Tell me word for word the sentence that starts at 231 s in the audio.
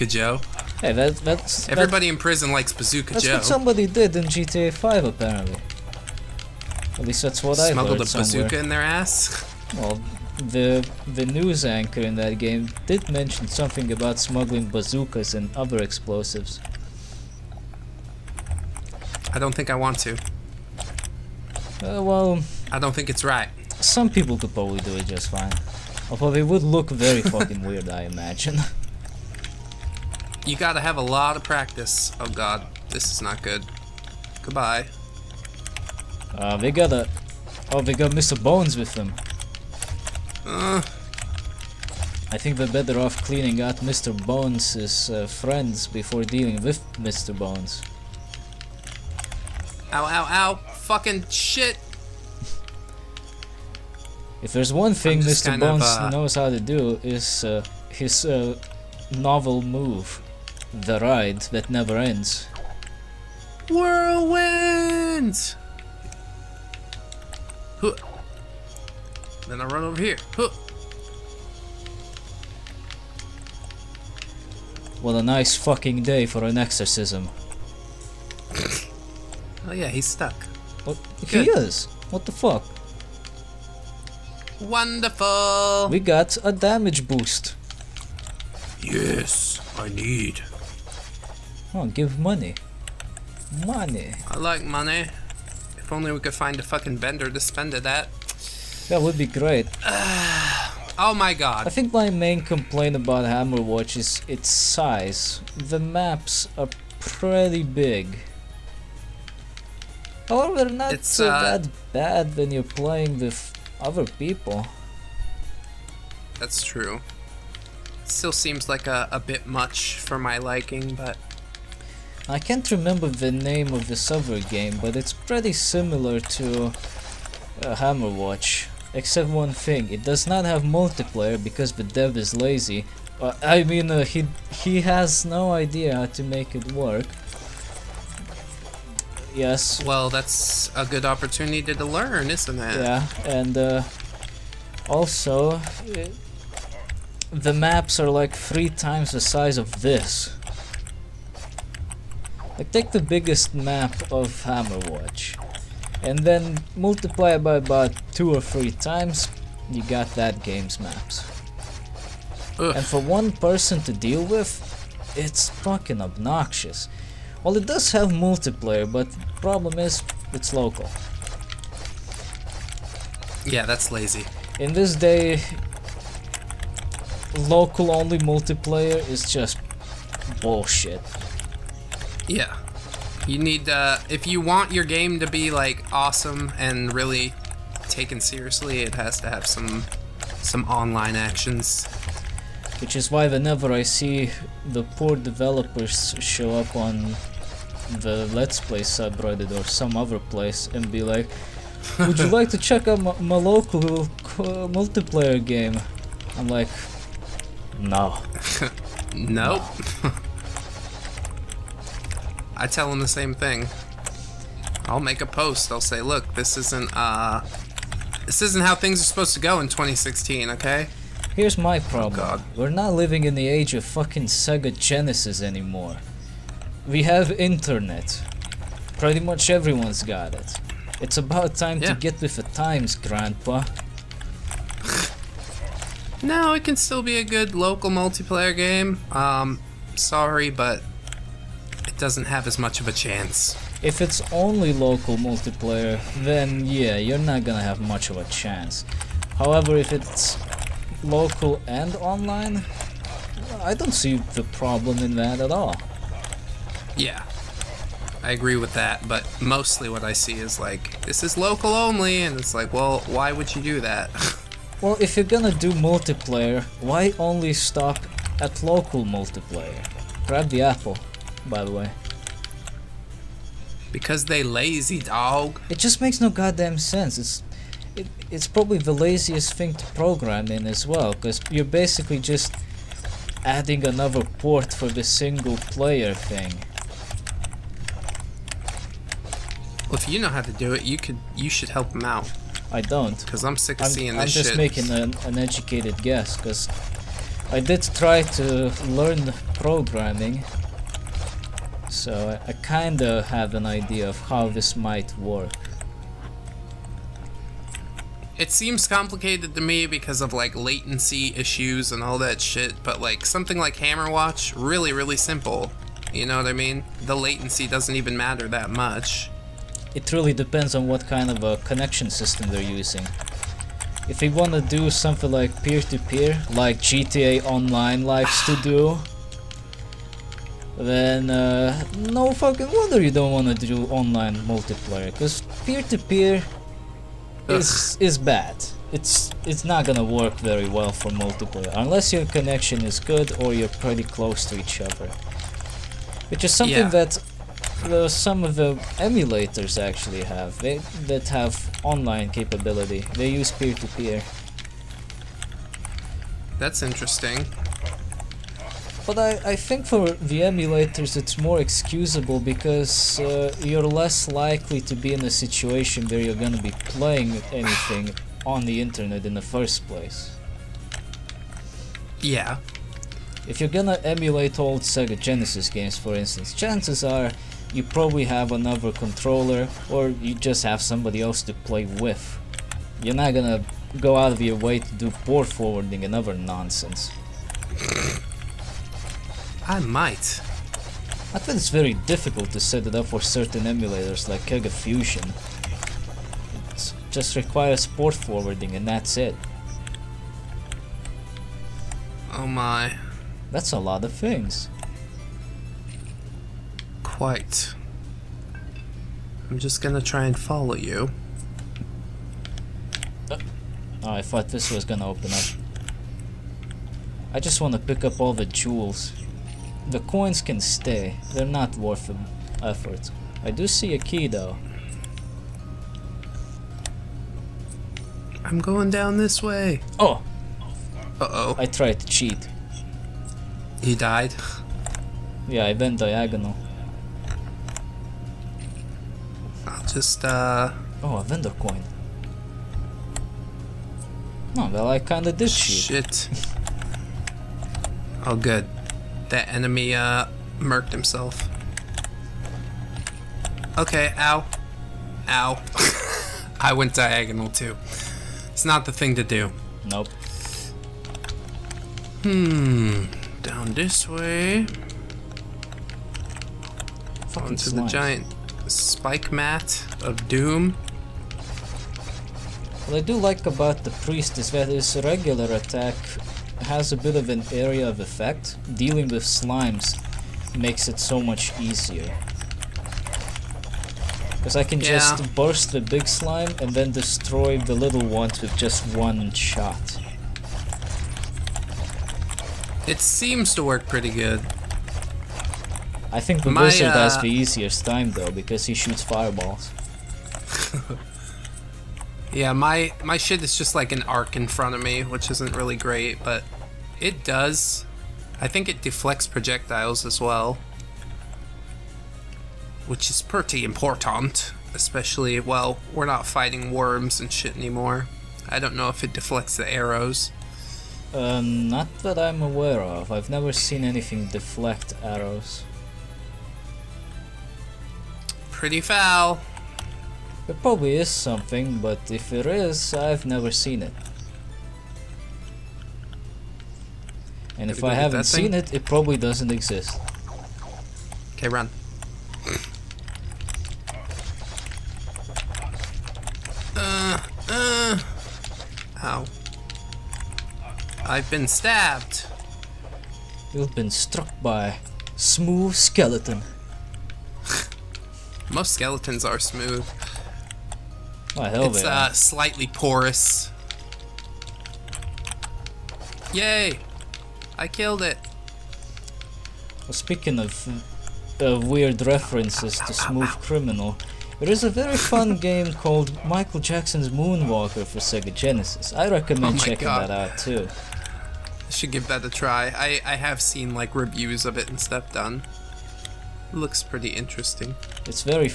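to get with the times, Grandpa.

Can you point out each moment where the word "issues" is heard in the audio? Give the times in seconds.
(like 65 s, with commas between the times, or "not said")
311 s.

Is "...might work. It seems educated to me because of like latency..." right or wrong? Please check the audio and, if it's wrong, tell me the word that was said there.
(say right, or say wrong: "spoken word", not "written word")
wrong: "complicated", not "educated".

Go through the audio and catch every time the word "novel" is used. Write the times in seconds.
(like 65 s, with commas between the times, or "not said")
59 s.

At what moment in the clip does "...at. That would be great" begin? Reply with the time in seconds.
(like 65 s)
97 s.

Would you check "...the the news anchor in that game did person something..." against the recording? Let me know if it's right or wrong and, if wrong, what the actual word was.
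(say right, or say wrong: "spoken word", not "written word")
wrong: "mention", not "person".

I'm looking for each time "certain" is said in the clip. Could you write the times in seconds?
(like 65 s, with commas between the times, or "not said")
393 s.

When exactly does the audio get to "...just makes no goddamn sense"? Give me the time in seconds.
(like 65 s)
275 s.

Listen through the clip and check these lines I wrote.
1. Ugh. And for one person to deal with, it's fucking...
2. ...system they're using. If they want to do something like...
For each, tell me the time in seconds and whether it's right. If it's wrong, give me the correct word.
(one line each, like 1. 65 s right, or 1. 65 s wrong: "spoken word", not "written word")
1. 162 s right
2. 322 s right.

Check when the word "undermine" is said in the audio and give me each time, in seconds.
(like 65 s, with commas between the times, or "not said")
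not said.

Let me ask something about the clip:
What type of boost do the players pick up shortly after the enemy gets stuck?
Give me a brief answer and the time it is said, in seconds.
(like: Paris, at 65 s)
Damage boost, at 86 s.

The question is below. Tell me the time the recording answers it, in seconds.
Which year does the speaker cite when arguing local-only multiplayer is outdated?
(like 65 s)
219 s.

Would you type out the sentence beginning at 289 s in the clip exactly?
Well, if you know how to do it, you could you should help him out.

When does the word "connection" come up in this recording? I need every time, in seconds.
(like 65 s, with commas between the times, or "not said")
321 s, 342 s.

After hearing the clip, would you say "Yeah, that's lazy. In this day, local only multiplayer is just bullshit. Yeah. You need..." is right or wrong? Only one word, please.
right.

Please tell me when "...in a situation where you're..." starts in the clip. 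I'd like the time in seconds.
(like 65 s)
365 s.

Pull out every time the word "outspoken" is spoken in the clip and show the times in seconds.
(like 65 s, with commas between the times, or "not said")
not said.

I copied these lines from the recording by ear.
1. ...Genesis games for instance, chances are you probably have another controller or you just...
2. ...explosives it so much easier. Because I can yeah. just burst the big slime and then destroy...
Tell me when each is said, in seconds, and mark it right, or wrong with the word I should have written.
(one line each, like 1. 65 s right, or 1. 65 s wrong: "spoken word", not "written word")
1. 375 s right
2. 480 s wrong: "makes", not "explosives".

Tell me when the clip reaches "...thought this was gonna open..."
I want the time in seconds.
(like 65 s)
414 s.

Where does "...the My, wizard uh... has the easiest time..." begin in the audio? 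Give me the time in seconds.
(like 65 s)
496 s.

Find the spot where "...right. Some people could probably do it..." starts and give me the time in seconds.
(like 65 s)
23 s.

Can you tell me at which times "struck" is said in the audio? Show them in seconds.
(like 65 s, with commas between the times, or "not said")
553 s.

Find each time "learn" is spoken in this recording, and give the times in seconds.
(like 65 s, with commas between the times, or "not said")
141 s, 298 s.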